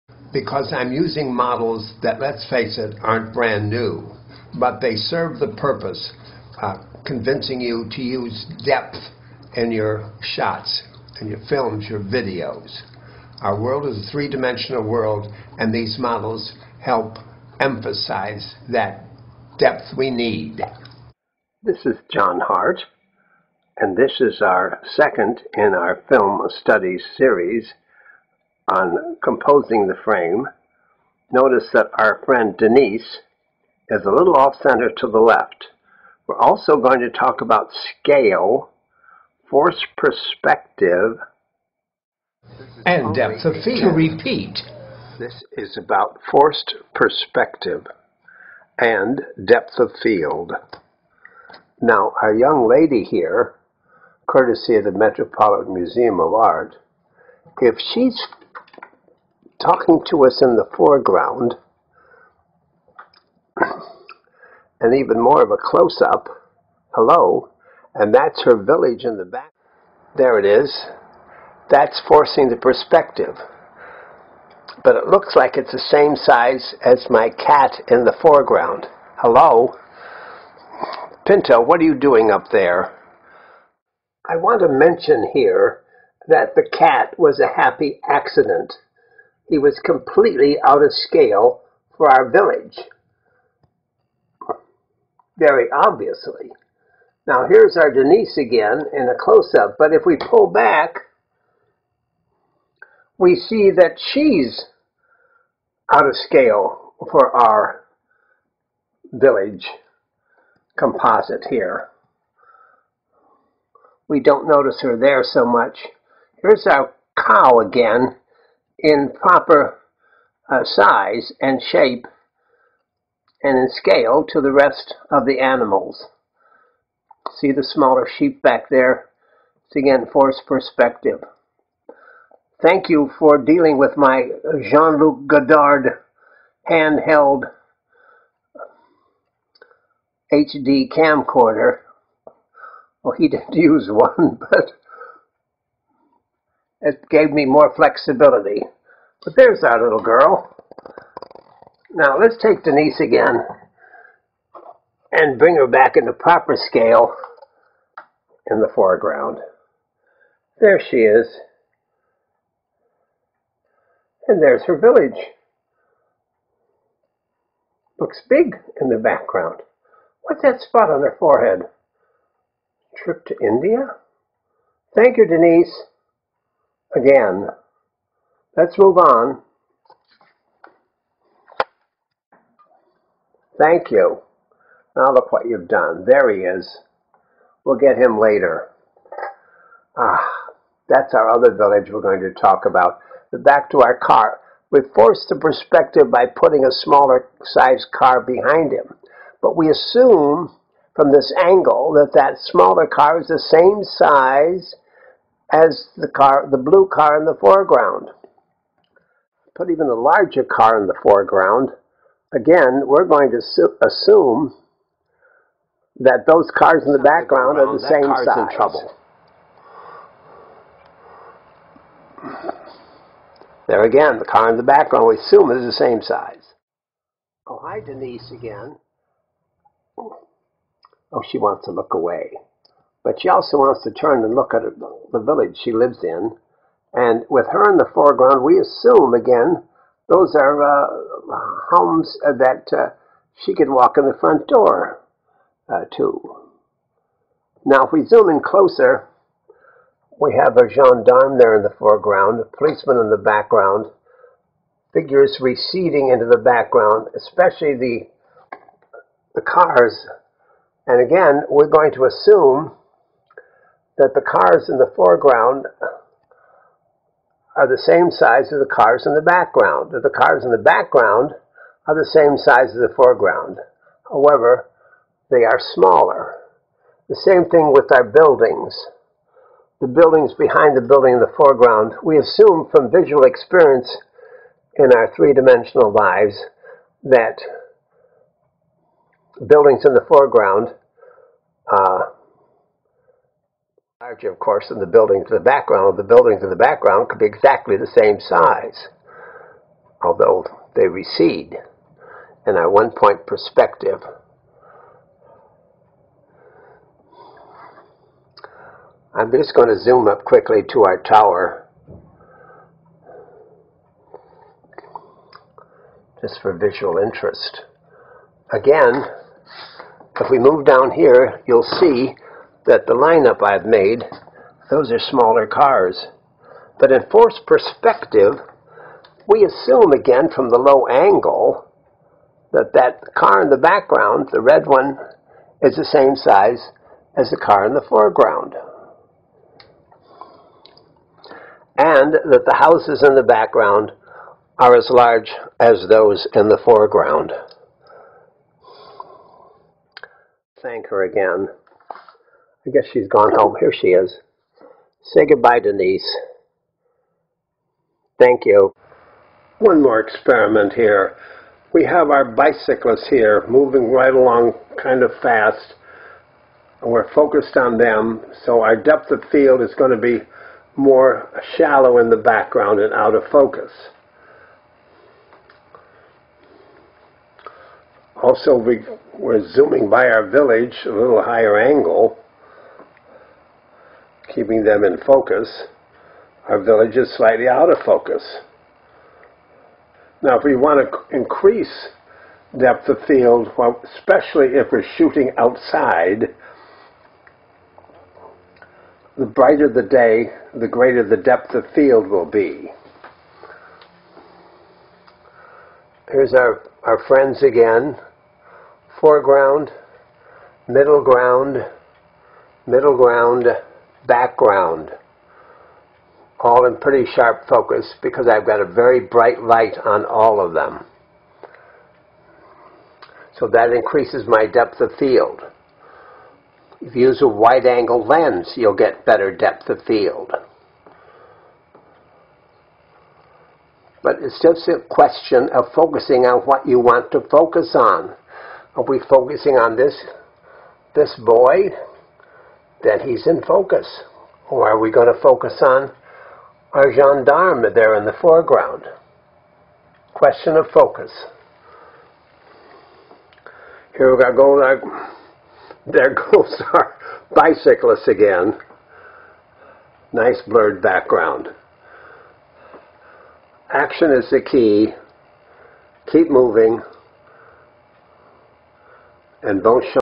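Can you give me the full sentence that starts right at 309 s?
I'm just going to zoom up quickly to our tower just for visual interest.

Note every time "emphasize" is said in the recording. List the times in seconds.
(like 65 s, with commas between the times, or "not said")
17 s.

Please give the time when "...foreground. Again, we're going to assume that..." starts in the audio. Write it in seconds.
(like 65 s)
211 s.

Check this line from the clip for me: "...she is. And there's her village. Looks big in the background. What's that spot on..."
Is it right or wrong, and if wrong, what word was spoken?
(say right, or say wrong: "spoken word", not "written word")
right.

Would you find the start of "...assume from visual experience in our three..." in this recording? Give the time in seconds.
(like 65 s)
282 s.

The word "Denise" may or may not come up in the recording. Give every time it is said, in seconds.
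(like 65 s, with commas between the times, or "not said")
32 s, 97 s, 152 s, 175 s, 227 s, 355 s.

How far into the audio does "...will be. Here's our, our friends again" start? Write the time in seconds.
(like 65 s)
402 s.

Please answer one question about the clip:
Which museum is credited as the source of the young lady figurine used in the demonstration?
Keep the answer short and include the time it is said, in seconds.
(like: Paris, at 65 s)
Metropolitan Museum of Art, at 54 s.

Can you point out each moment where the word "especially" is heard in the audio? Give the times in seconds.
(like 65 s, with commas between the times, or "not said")
257 s, 393 s.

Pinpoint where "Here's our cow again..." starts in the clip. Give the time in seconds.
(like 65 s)
116 s.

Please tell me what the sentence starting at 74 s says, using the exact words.
But it looks like it's the same size as my cat in the foreground.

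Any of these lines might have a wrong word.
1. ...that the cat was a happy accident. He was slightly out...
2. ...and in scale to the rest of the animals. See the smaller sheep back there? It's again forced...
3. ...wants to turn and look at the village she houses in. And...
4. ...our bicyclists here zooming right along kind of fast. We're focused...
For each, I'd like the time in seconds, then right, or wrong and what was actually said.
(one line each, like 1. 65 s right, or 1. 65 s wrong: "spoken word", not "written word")
1. 86 s wrong: "completely", not "slightly"
2. 123 s right
3. 233 s wrong: "lives", not "houses"
4. 362 s wrong: "moving", not "zooming".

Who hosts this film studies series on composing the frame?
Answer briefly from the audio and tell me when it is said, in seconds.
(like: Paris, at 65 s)
John Hart, at 22 s.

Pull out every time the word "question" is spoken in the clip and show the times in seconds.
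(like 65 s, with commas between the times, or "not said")
434 s, 450 s.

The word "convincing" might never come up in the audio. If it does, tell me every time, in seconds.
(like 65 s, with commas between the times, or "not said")
7 s.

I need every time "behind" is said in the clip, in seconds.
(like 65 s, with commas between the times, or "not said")
198 s, 280 s.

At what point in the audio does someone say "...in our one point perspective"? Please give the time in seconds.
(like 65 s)
302 s.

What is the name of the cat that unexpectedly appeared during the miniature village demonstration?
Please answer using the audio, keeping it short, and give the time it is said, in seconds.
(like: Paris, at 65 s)
Pinto, at 81 s.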